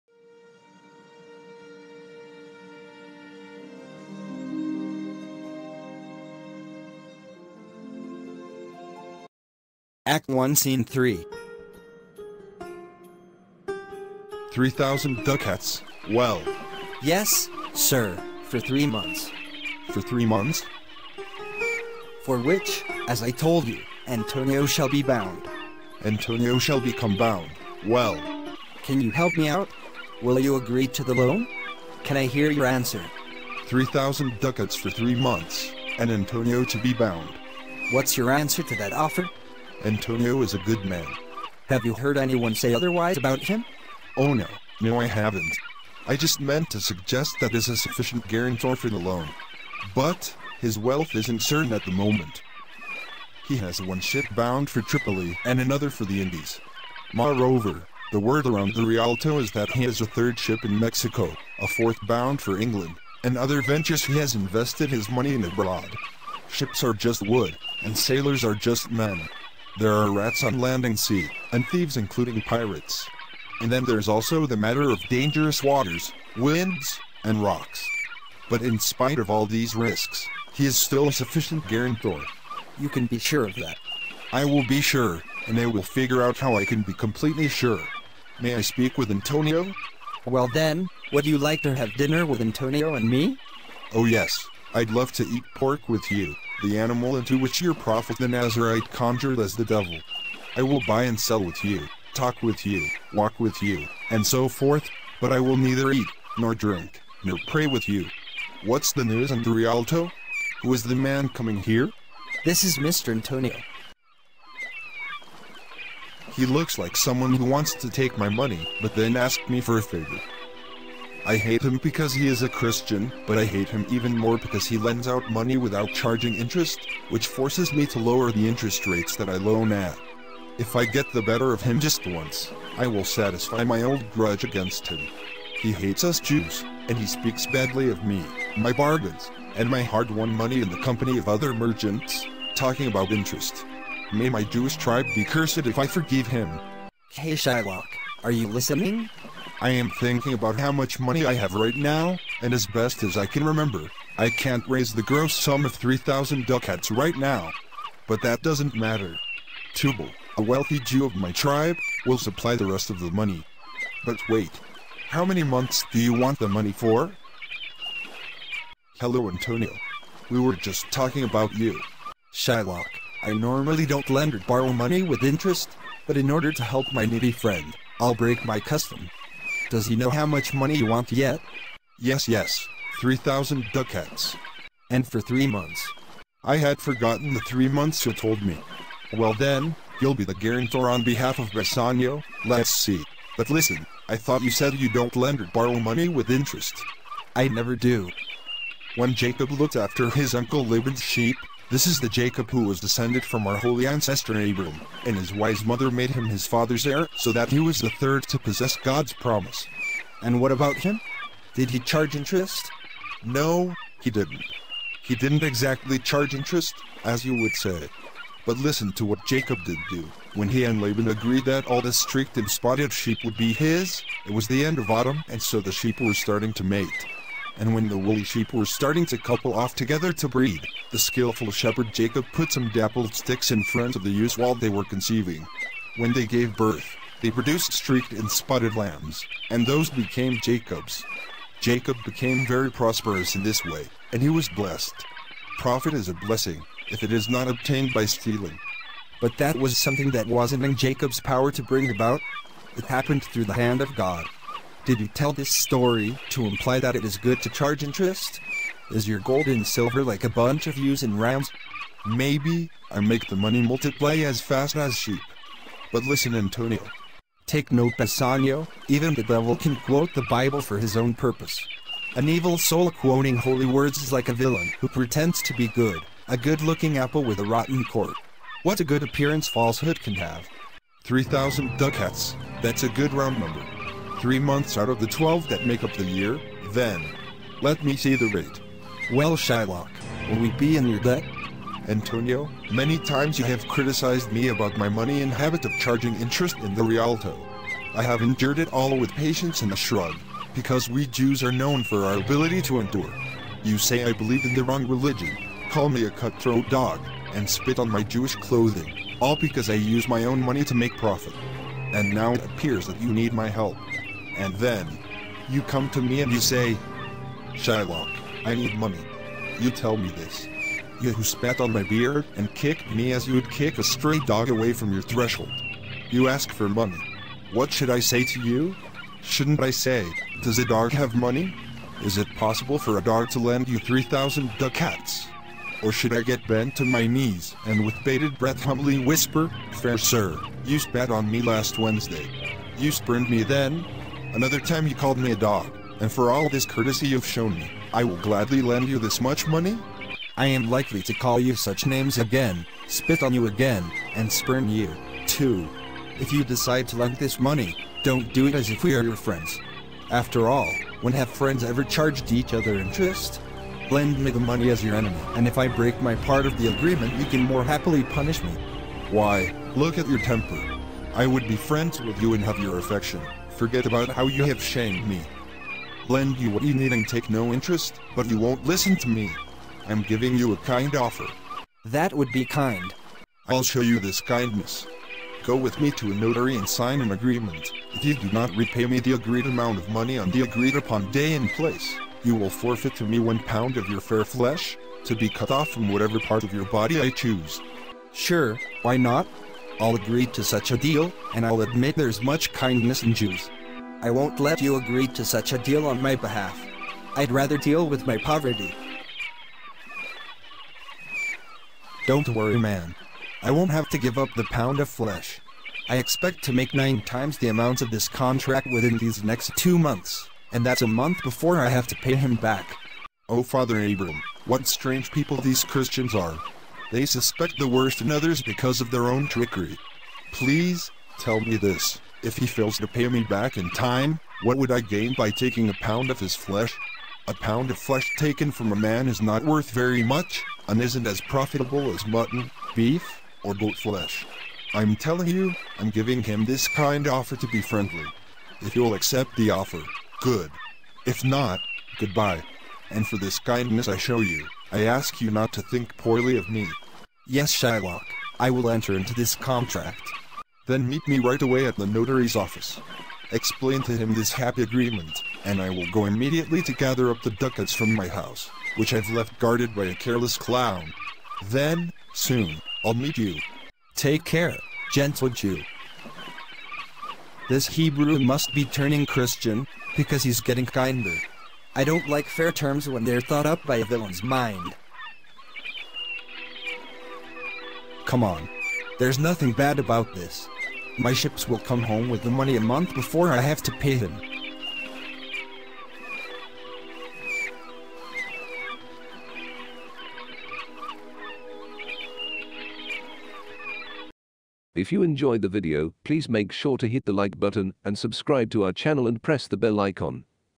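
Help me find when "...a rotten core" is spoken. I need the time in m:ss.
4:37.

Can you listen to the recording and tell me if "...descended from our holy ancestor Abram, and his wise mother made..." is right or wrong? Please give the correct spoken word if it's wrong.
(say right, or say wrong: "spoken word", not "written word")
right.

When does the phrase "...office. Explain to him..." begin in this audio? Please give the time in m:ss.
7:42.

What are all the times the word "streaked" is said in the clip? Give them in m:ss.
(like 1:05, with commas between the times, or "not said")
3:41, 3:57.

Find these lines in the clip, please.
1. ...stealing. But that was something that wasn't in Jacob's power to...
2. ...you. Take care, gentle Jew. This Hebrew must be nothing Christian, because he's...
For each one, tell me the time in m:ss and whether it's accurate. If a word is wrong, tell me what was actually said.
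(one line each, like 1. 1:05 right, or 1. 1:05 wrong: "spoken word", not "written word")
1. 4:08 right
2. 7:53 wrong: "turning", not "nothing".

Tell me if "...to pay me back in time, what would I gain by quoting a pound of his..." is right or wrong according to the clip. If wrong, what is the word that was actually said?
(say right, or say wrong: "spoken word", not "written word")
wrong: "taking", not "quoting".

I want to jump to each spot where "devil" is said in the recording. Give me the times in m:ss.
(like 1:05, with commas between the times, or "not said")
1:39, 4:29.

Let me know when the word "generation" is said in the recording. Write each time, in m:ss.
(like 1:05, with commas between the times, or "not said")
not said.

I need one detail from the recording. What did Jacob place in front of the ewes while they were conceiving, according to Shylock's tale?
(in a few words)
dappled sticks.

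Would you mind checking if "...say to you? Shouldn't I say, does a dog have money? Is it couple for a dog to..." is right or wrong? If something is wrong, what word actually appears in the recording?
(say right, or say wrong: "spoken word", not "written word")
wrong: "possible", not "couple".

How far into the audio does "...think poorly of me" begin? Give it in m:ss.
7:35.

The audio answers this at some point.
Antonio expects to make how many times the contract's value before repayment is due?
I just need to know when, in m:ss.
6:56.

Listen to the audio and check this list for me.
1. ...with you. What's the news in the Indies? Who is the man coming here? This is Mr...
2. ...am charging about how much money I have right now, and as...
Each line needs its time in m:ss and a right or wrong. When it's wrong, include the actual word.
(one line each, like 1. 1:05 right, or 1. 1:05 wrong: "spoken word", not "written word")
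1. 1:47 wrong: "Rialto", not "Indies"
2. 2:29 wrong: "thinking", not "charging".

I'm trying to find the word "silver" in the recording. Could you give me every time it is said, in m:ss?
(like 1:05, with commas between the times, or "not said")
4:19.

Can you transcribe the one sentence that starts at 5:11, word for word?
And now it appears that you need my help.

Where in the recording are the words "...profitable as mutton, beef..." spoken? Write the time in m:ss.
7:21.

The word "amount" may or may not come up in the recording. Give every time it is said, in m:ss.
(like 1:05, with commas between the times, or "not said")
6:29, 6:57.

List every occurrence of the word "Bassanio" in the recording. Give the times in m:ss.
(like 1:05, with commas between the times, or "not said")
3:11, 4:27.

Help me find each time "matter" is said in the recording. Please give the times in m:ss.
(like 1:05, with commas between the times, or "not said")
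1:14, 2:38.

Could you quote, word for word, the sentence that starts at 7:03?
Oh, Father Abram, what strange people these Christians are.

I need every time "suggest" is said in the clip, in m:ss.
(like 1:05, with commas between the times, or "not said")
0:46.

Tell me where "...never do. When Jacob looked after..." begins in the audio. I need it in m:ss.
3:17.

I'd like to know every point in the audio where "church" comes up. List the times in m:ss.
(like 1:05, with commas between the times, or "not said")
not said.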